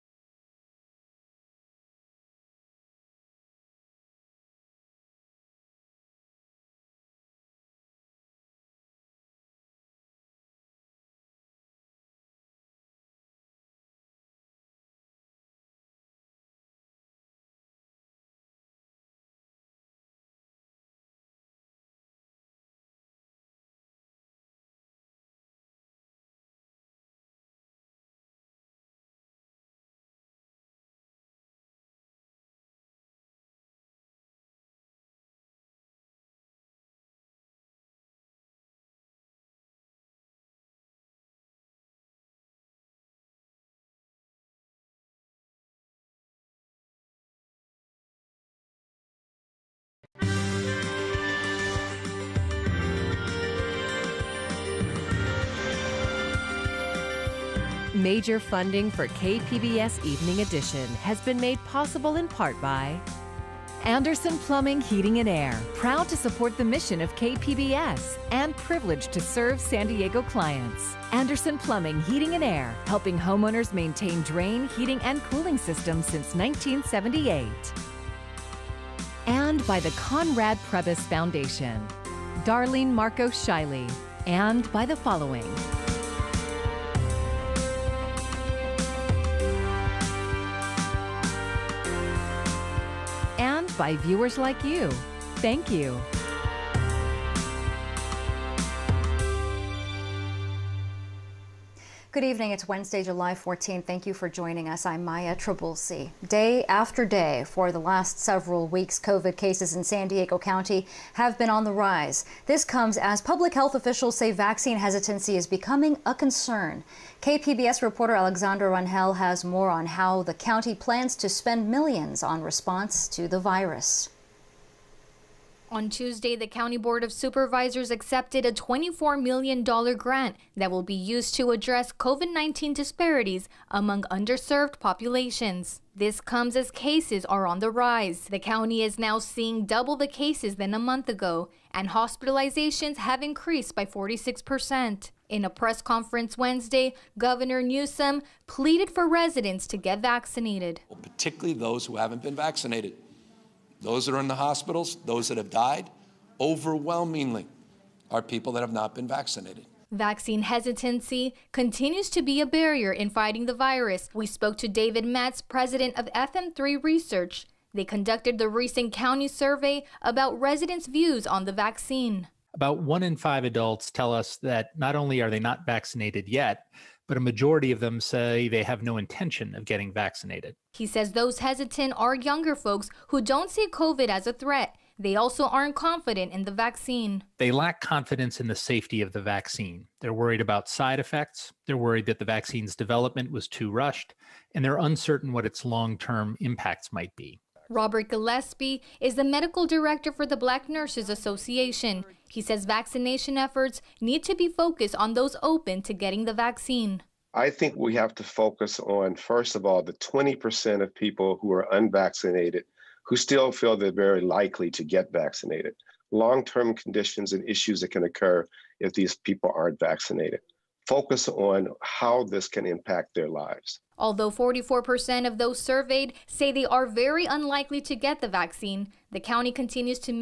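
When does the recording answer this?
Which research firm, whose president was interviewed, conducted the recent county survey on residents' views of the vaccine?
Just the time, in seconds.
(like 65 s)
166 s.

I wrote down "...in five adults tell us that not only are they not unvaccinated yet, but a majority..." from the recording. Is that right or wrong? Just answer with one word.
wrong.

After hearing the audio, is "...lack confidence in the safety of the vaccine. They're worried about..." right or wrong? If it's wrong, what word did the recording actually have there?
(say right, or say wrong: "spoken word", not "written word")
right.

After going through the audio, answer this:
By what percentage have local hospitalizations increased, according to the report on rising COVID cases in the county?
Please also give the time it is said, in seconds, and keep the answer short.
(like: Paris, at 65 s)
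46%, at 143 s.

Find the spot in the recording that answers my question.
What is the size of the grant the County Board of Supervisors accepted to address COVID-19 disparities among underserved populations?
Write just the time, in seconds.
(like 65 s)
128 s.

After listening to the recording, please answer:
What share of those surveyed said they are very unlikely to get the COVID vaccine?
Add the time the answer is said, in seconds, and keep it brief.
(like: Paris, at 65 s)
44%, at 224 s.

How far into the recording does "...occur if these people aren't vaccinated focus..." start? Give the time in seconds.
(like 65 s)
218 s.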